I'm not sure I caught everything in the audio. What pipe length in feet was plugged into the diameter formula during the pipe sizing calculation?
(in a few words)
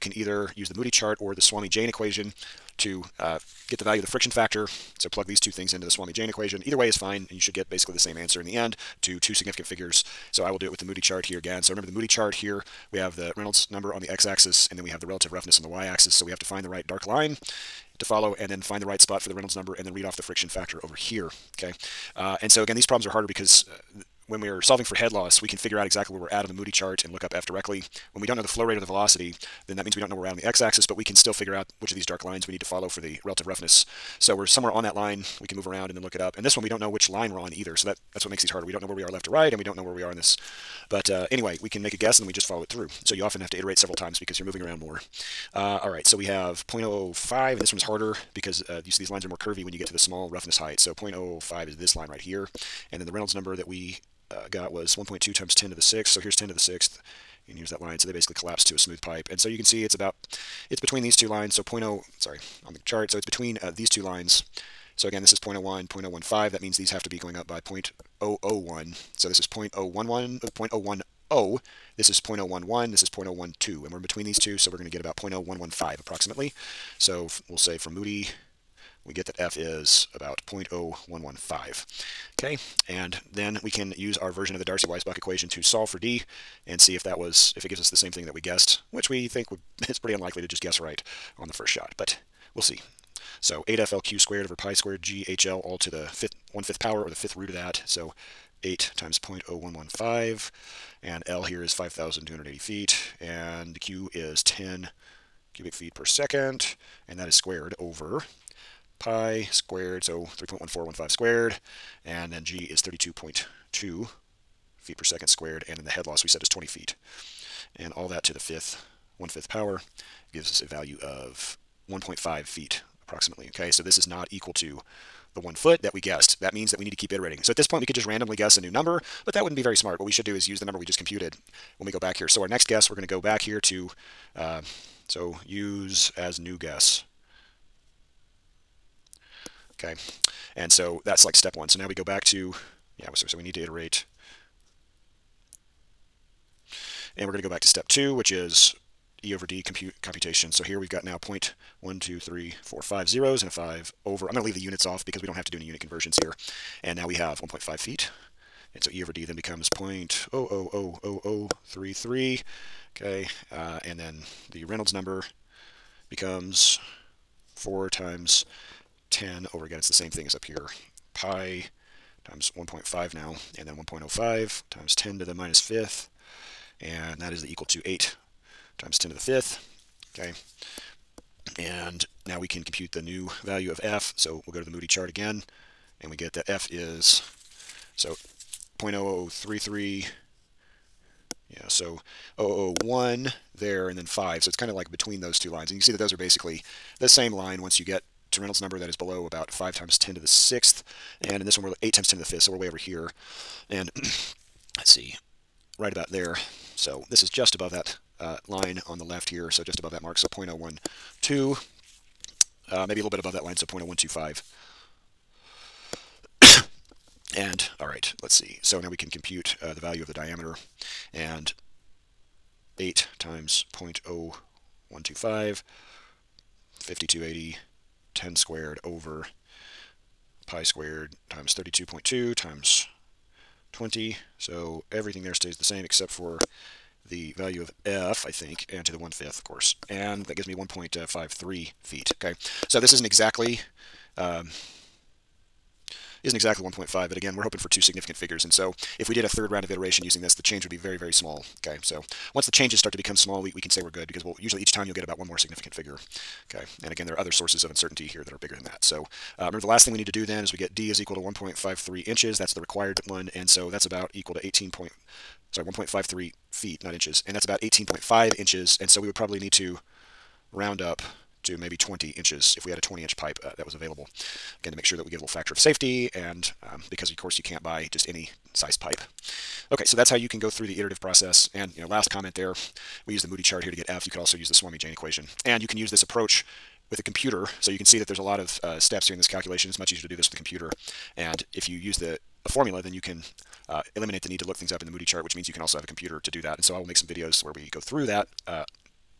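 5,280 feet.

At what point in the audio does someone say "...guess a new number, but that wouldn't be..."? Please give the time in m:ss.
2:08.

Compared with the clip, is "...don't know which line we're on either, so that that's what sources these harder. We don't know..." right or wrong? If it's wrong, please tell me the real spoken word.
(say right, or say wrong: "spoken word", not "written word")
wrong: "makes", not "sources".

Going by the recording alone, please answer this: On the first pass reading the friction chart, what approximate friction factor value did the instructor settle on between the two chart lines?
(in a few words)
0.0115.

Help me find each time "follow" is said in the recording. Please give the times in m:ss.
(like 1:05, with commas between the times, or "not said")
0:18, 0:32, 0:42.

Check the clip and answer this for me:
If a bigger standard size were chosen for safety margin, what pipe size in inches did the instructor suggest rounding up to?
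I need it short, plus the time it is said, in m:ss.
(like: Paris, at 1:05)
20 inches, at 4:31.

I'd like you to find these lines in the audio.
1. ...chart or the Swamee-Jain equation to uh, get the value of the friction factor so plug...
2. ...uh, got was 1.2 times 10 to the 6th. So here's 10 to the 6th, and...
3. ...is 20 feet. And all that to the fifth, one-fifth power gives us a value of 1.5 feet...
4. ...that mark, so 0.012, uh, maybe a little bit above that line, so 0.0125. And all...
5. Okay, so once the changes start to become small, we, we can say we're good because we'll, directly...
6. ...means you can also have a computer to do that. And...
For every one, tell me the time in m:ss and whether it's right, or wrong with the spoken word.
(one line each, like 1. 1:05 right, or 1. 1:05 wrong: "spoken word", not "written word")
1. 0:00 right
2. 0:54 right
3. 1:56 right
4. 3:29 right
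5. 4:11 wrong: "usually", not "directly"
6. 4:55 right.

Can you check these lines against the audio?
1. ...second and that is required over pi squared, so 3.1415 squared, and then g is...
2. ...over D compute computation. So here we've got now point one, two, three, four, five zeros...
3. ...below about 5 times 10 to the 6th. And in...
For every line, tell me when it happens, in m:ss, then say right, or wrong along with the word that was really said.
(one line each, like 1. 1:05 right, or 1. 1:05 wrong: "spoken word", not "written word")
1. 1:46 wrong: "squared", not "required"
2. 2:29 right
3. 3:18 right.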